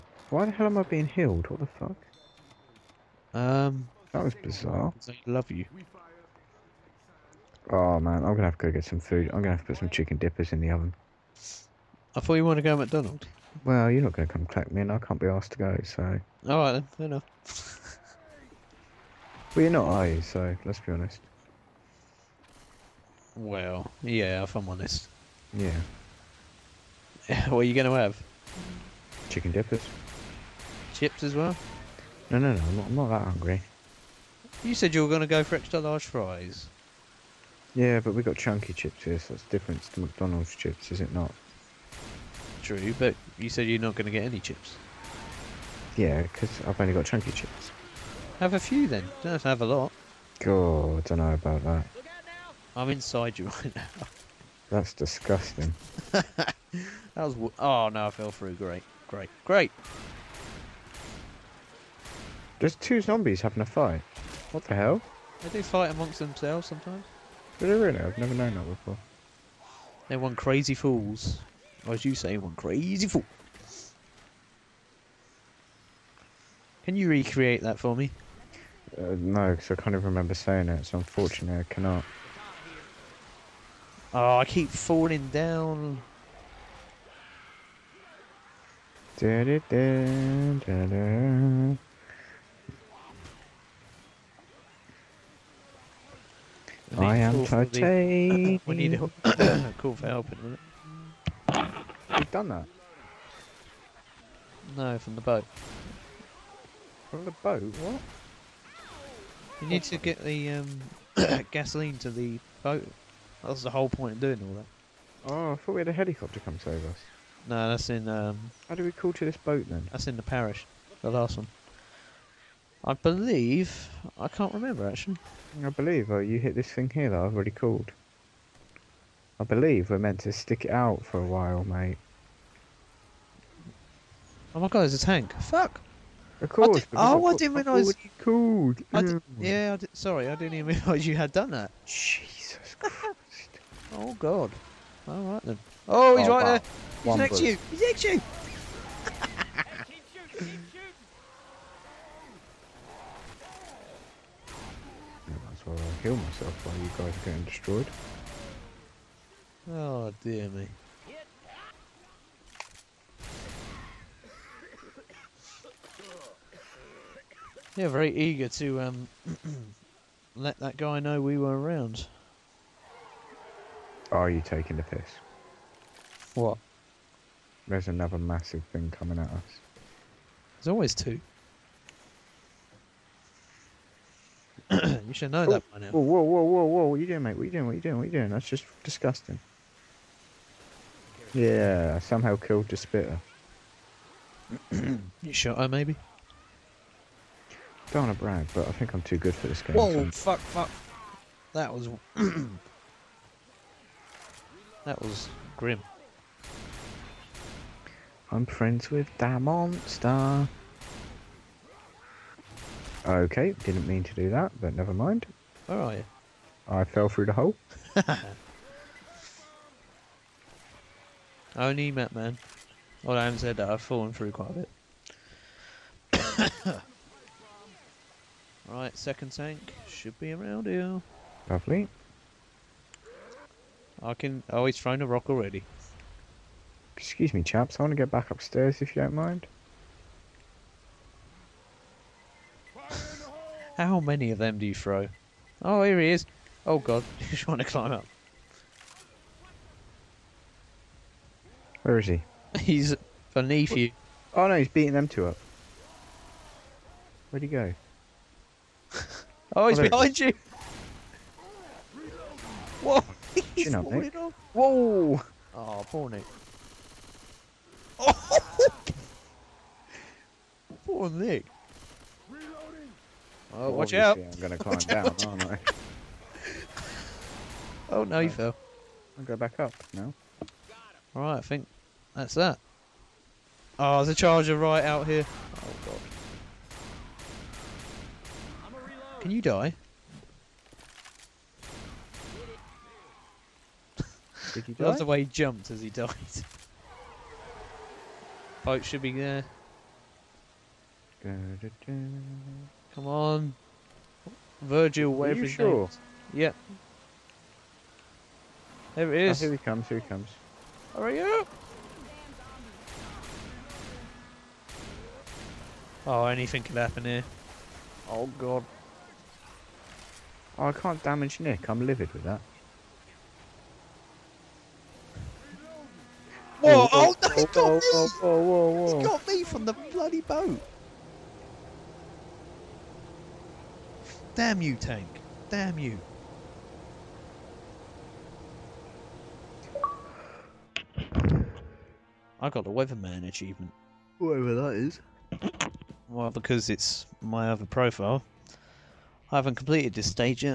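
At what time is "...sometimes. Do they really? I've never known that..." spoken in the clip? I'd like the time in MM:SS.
01:06.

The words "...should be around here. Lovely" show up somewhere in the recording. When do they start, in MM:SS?
03:49.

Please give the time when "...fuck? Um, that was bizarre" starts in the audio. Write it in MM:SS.
00:01.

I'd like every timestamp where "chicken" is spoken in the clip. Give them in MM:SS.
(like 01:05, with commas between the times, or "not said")
00:09, 00:29.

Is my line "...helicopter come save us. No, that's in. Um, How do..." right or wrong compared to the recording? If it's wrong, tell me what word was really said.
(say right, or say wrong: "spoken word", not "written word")
right.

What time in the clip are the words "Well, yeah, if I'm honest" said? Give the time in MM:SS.
00:23.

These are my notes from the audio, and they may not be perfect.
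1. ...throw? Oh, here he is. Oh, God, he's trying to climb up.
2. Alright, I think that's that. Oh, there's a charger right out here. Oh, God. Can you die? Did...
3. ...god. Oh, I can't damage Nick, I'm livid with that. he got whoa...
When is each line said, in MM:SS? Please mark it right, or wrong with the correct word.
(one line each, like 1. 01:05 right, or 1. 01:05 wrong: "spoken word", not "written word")
1. 04:04 right
2. 04:41 right
3. 05:18 right.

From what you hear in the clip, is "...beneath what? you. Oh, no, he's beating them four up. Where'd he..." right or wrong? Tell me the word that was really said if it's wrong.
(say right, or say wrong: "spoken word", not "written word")
wrong: "two", not "four".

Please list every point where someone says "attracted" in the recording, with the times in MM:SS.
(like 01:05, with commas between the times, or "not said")
not said.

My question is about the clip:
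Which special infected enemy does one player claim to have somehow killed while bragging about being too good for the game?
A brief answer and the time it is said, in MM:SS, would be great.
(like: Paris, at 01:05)
Spitter, at 03:12.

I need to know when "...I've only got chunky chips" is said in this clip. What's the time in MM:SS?
00:46.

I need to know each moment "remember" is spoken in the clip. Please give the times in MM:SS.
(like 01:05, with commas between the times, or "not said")
01:20, 02:04.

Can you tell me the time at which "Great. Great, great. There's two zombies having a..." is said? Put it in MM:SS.
00:58.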